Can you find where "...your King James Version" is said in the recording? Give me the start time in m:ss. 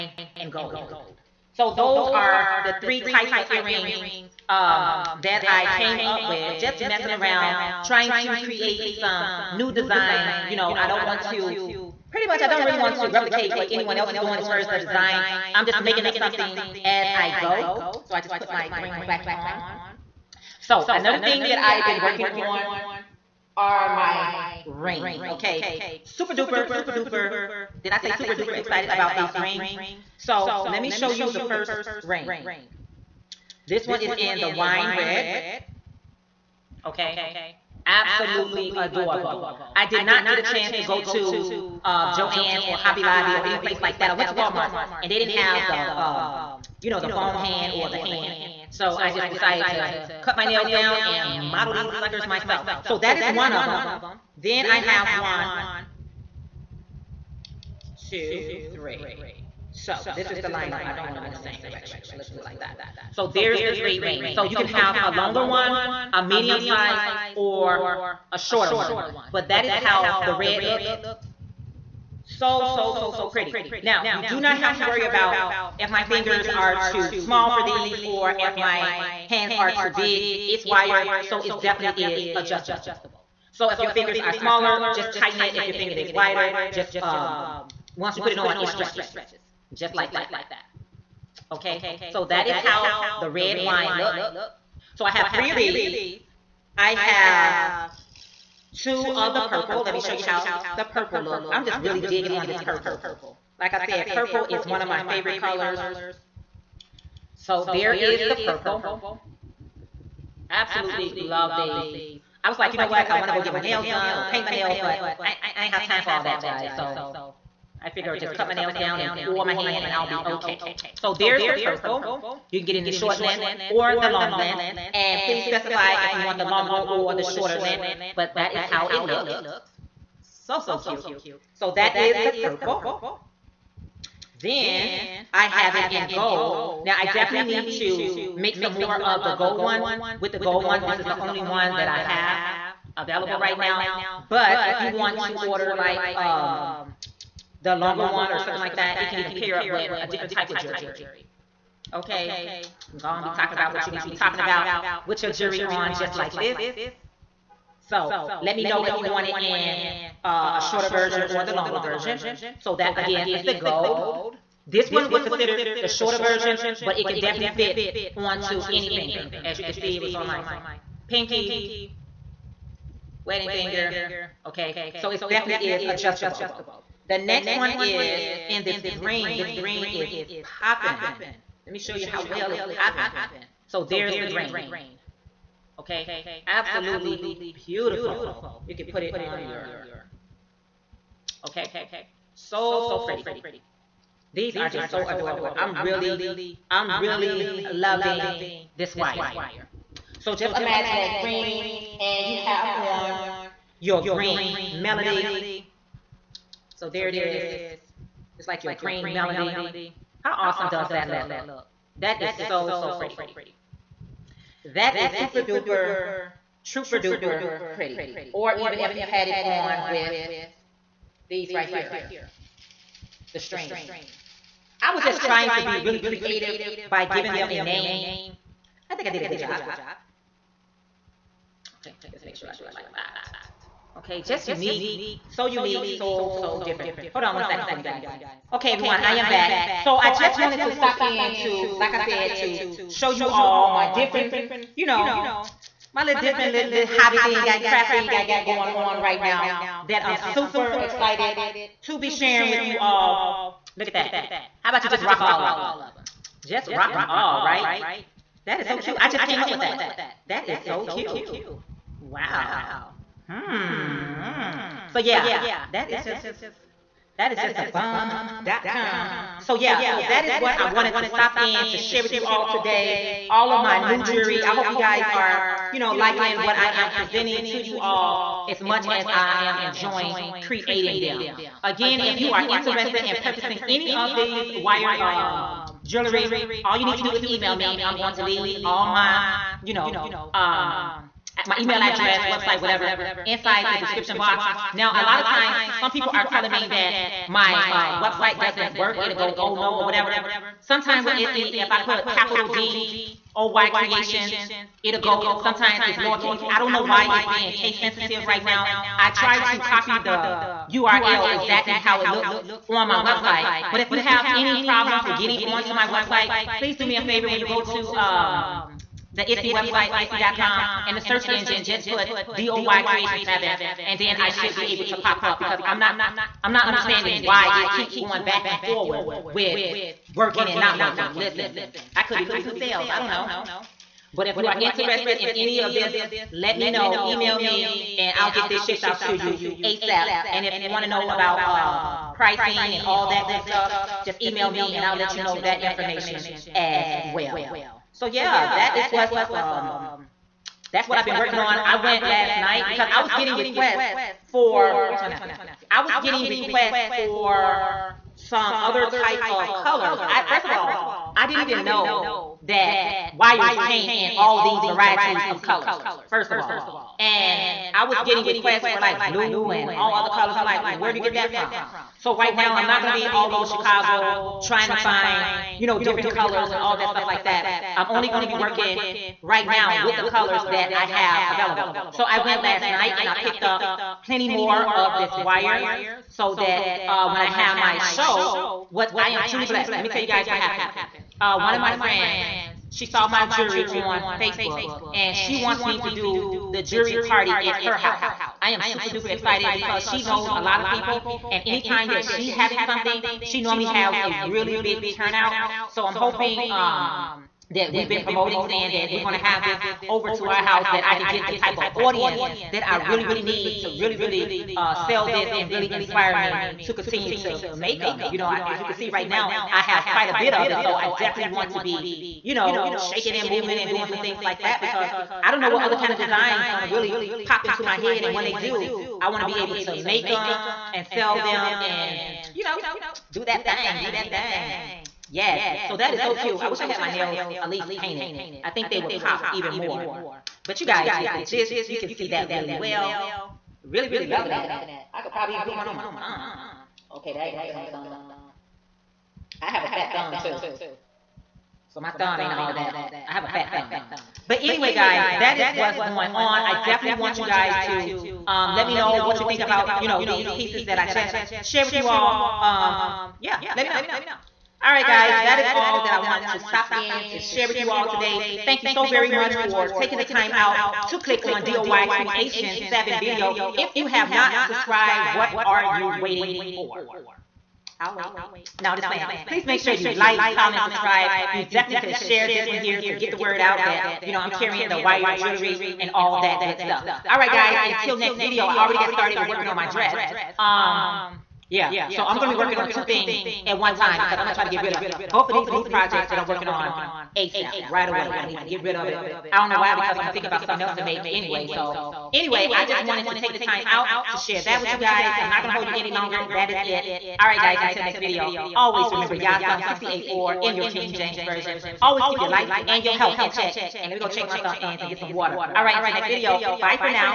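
8:30.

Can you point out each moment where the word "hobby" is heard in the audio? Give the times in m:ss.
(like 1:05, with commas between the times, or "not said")
0:42, 4:06.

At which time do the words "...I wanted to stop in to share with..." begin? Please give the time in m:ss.
4:30.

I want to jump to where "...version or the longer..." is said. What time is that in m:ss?
2:40.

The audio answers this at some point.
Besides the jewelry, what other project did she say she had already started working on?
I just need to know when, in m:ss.
8:09.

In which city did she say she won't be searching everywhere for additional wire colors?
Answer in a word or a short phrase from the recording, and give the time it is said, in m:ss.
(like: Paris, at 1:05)
Chicago, at 6:13.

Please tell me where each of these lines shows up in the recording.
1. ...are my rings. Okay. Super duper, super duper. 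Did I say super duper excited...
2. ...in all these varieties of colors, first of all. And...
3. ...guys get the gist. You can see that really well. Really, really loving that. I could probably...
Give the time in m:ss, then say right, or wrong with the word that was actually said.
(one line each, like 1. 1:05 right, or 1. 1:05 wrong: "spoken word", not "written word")
1. 0:23 right
2. 6:03 right
3. 7:20 right.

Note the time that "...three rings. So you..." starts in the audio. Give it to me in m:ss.
1:03.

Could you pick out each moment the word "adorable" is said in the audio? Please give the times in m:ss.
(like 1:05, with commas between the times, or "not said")
0:38, 3:15.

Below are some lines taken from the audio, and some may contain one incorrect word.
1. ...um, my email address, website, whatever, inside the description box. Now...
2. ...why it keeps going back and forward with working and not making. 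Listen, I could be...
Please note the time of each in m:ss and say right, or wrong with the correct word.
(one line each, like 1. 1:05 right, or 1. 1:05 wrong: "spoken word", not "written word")
1. 4:50 right
2. 5:27 wrong: "working", not "making".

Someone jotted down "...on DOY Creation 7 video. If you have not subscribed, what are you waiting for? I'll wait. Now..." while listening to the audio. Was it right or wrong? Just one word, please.
right.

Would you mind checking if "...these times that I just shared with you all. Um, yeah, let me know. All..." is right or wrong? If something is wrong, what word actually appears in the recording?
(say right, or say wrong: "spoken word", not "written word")
wrong: "pieces", not "times".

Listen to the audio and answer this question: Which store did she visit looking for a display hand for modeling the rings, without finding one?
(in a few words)
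Walmart.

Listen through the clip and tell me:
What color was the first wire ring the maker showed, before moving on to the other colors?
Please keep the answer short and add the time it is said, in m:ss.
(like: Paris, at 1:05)
wine red, at 0:34.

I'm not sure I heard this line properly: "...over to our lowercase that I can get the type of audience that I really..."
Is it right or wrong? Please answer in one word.
wrong.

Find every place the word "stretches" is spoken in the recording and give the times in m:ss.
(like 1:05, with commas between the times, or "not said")
1:28.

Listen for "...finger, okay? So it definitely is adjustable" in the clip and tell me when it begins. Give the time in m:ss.
2:53.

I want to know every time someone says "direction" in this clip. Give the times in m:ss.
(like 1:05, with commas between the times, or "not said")
1:01.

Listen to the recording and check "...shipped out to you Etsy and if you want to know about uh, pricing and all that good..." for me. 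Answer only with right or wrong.
wrong.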